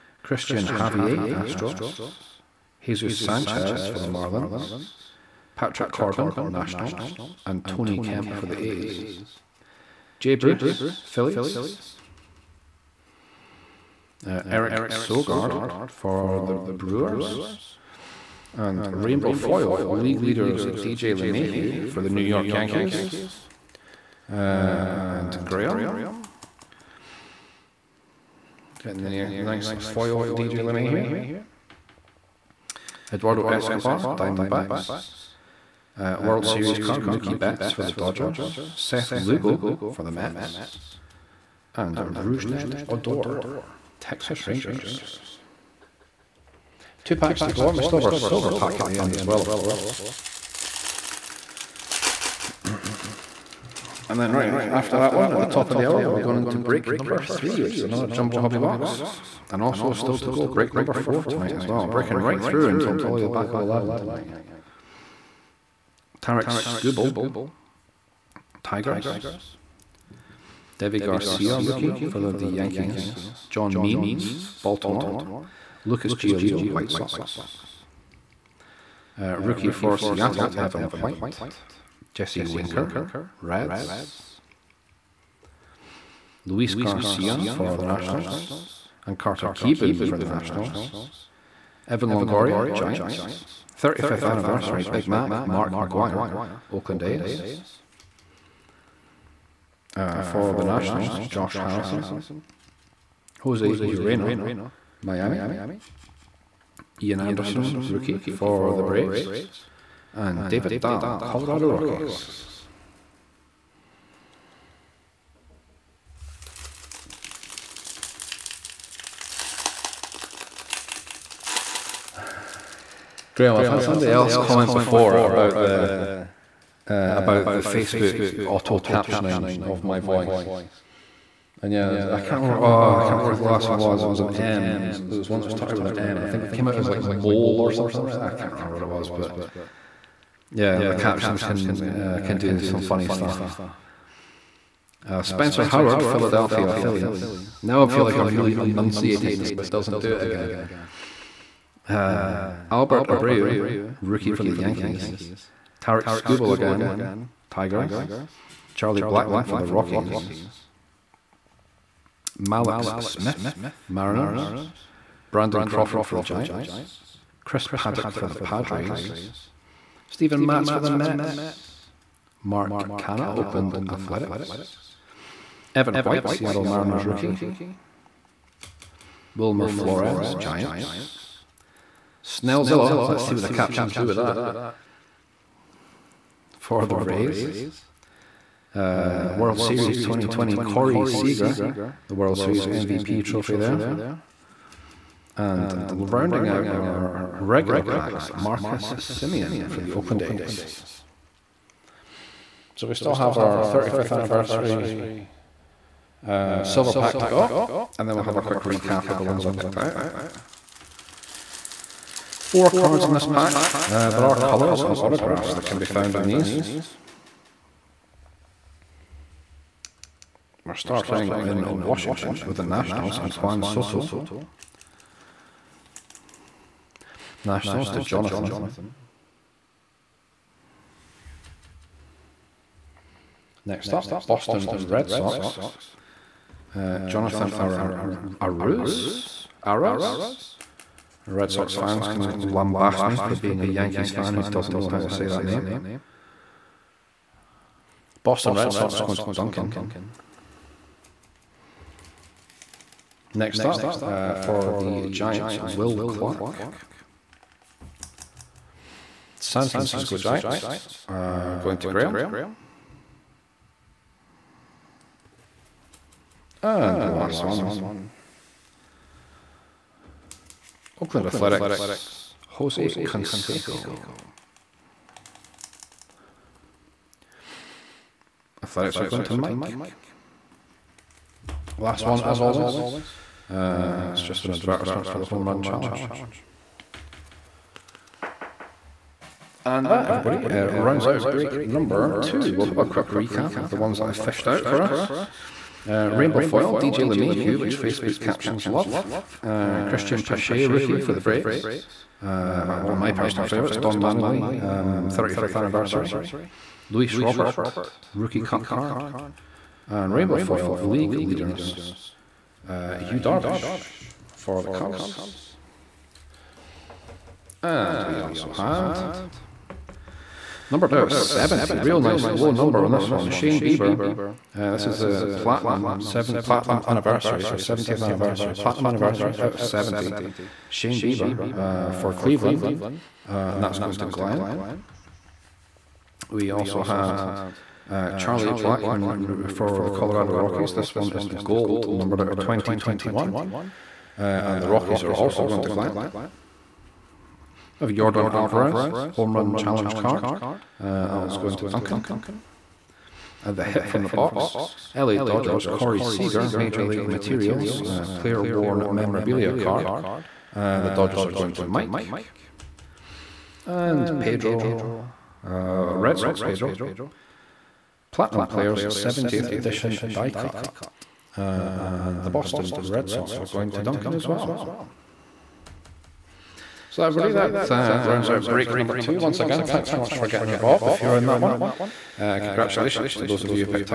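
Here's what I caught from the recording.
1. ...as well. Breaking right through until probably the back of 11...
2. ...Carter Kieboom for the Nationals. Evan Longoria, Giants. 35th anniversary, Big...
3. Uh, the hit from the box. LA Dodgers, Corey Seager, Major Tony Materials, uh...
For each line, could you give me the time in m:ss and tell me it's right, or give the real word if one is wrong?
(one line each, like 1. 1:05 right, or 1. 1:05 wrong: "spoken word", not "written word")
1. 1:01 right
2. 1:29 right
3. 5:53 wrong: "League", not "Tony".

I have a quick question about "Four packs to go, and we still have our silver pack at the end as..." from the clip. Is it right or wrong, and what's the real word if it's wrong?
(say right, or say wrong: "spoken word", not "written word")
wrong: "Two", not "Four".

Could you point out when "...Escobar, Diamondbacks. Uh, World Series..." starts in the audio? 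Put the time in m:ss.
0:33.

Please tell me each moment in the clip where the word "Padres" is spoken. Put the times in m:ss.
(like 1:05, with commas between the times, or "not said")
2:48.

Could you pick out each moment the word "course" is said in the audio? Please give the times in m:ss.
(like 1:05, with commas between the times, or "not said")
0:49.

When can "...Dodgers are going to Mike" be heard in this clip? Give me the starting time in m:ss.
6:00.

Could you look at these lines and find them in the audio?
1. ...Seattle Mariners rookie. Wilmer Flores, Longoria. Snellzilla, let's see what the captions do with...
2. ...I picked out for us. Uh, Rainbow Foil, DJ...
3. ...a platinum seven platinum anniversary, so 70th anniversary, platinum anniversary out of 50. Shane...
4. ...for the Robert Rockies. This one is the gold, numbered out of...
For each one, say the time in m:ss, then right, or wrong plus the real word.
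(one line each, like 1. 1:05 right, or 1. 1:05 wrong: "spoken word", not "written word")
1. 2:56 wrong: "Giants", not "Longoria"
2. 4:54 wrong: "fished", not "picked"
3. 5:25 wrong: "70", not "50"
4. 5:39 wrong: "Colorado", not "Robert".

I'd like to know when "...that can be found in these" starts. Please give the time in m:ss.
3:35.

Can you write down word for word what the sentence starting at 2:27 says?
Now I feel like I'm really enunciating, so it doesn't do it again.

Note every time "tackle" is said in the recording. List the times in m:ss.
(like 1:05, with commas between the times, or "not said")
not said.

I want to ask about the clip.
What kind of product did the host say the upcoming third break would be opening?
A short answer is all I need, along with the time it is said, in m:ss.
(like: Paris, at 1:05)
Jumbo Hobby box, at 0:58.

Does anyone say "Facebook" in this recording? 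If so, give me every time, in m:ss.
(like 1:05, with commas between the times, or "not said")
2:07, 4:57.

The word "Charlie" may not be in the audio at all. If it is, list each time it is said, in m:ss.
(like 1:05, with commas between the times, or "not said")
2:38, 5:38.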